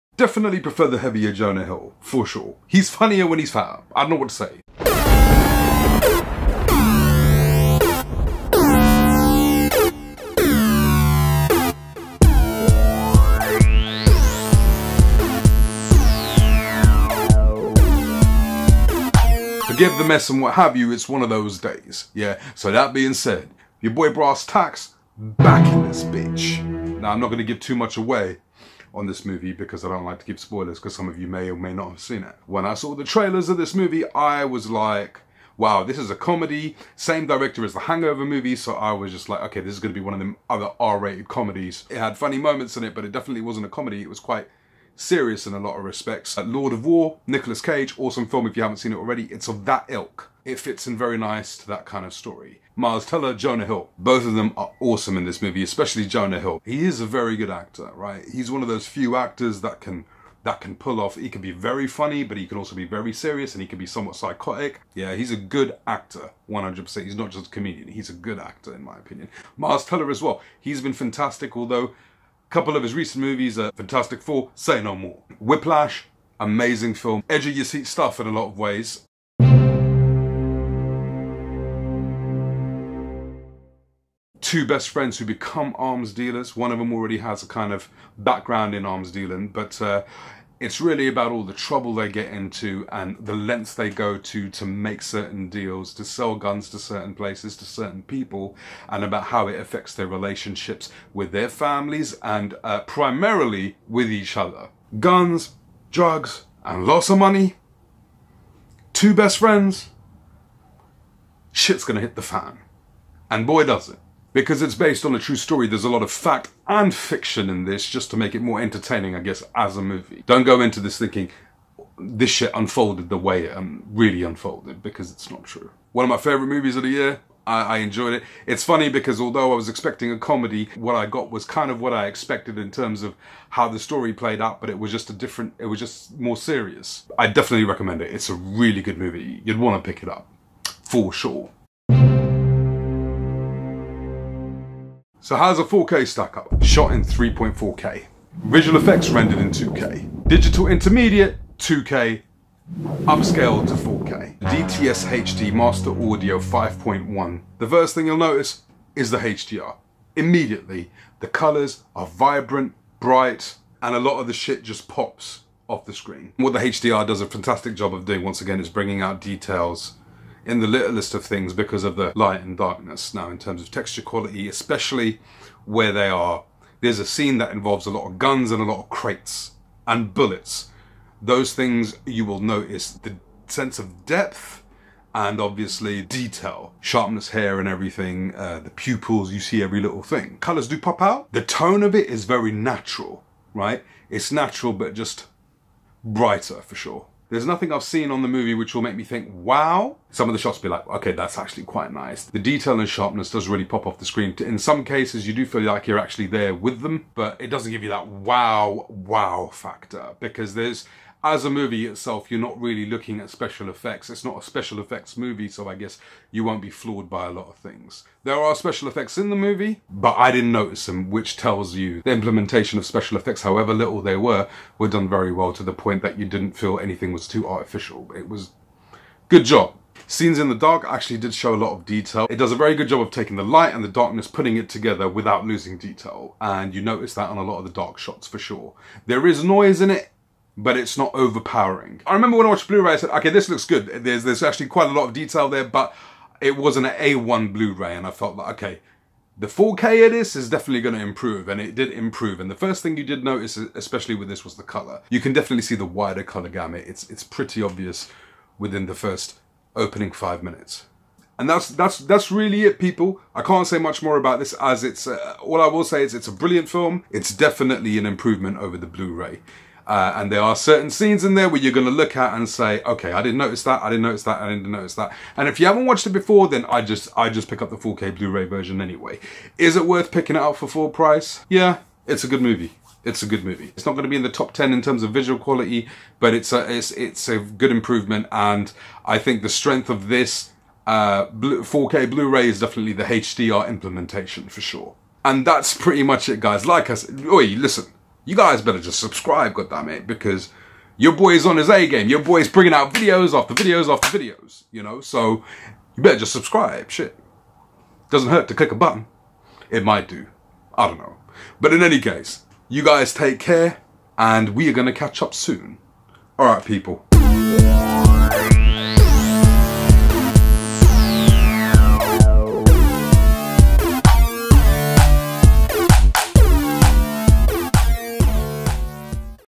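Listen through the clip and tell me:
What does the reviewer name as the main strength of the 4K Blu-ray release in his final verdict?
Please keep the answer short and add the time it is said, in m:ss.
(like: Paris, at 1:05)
HDR implementation, at 4:53.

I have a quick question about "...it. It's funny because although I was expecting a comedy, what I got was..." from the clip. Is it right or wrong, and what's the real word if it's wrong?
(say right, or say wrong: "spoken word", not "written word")
right.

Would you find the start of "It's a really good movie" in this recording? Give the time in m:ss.
2:18.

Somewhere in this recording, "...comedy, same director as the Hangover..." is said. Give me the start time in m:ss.
0:36.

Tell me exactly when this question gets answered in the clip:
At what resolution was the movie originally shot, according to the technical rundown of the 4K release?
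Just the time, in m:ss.
2:27.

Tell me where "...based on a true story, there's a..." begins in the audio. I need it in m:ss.
1:54.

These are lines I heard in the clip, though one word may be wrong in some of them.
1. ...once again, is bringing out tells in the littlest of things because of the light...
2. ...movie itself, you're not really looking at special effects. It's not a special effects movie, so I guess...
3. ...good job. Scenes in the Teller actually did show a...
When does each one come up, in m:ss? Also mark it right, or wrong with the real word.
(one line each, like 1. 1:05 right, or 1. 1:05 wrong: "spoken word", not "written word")
1. 2:48 wrong: "details", not "tells"
2. 3:31 right
3. 3:49 wrong: "Dark", not "Teller".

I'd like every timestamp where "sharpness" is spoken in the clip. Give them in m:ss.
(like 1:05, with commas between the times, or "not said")
3:06, 3:22.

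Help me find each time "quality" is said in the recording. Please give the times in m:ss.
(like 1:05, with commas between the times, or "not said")
2:54, 4:45.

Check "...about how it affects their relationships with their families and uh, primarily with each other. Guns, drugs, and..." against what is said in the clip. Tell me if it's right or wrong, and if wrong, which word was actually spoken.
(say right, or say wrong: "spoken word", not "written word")
right.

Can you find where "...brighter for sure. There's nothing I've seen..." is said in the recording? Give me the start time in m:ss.
3:16.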